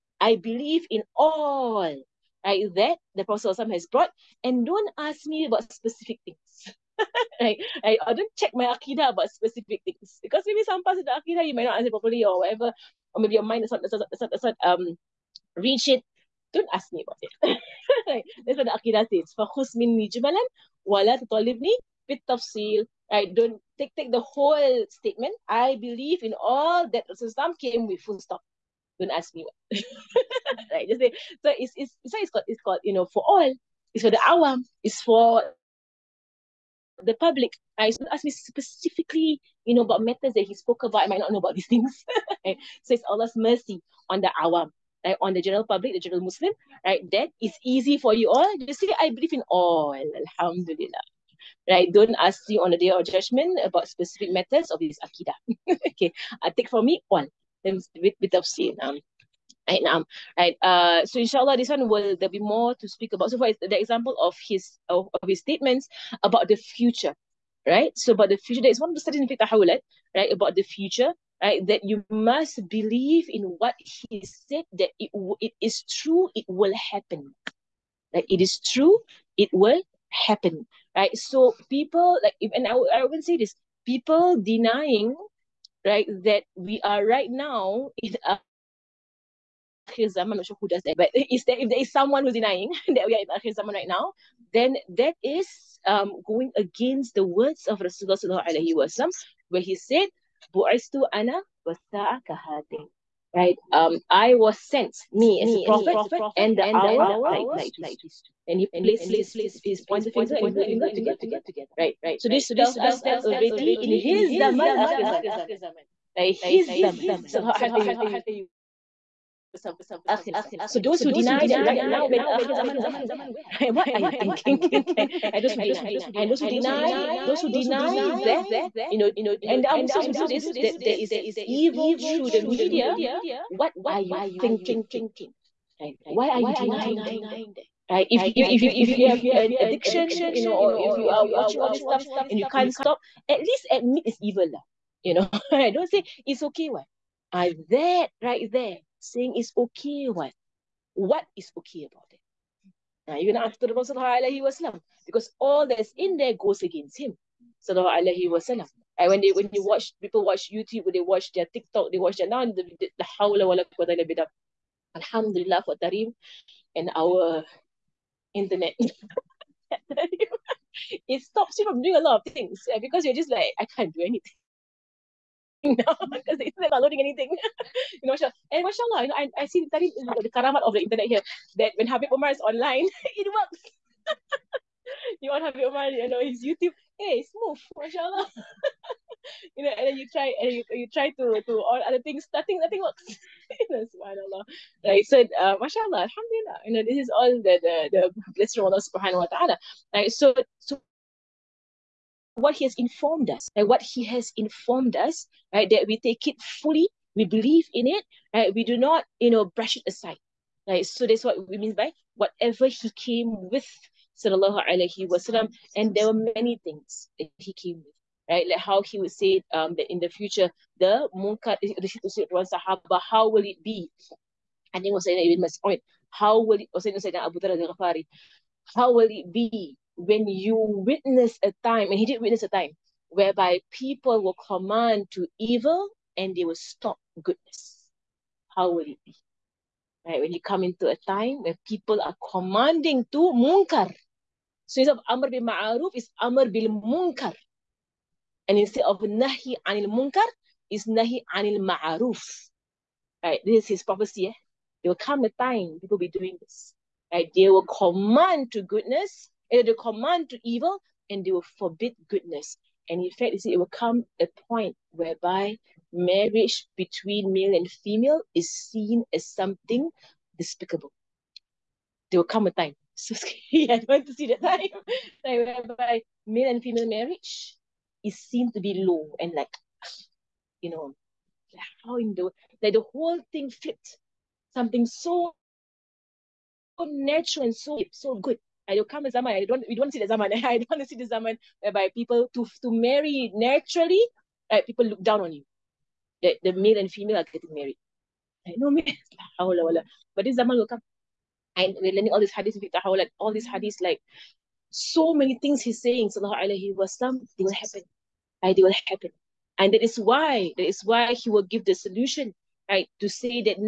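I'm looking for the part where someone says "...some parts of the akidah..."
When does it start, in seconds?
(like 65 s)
10 s.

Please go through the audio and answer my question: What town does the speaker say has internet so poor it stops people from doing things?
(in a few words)
Tarim.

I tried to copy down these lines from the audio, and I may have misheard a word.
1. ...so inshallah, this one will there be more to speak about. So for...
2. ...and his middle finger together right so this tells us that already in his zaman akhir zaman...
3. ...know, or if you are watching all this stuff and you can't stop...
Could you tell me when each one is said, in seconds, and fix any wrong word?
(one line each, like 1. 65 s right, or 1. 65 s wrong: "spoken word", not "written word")
1. 61 s right
2. 110 s right
3. 140 s right.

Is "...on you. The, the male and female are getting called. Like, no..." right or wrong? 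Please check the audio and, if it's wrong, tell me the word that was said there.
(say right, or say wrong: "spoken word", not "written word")
wrong: "married", not "called".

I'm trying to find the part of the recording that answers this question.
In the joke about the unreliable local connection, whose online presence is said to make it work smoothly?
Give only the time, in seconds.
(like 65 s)
181 s.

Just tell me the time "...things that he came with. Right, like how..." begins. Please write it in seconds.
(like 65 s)
216 s.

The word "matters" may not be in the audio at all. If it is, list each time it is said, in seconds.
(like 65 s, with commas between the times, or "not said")
40 s, 54 s.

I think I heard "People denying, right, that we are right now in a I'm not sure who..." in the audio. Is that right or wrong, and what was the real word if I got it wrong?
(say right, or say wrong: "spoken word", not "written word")
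right.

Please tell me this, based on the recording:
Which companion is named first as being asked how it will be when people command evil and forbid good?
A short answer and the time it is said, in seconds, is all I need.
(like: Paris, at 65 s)
Ibn Mas'ud, at 225 s.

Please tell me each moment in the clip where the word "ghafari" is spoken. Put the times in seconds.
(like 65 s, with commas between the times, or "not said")
227 s.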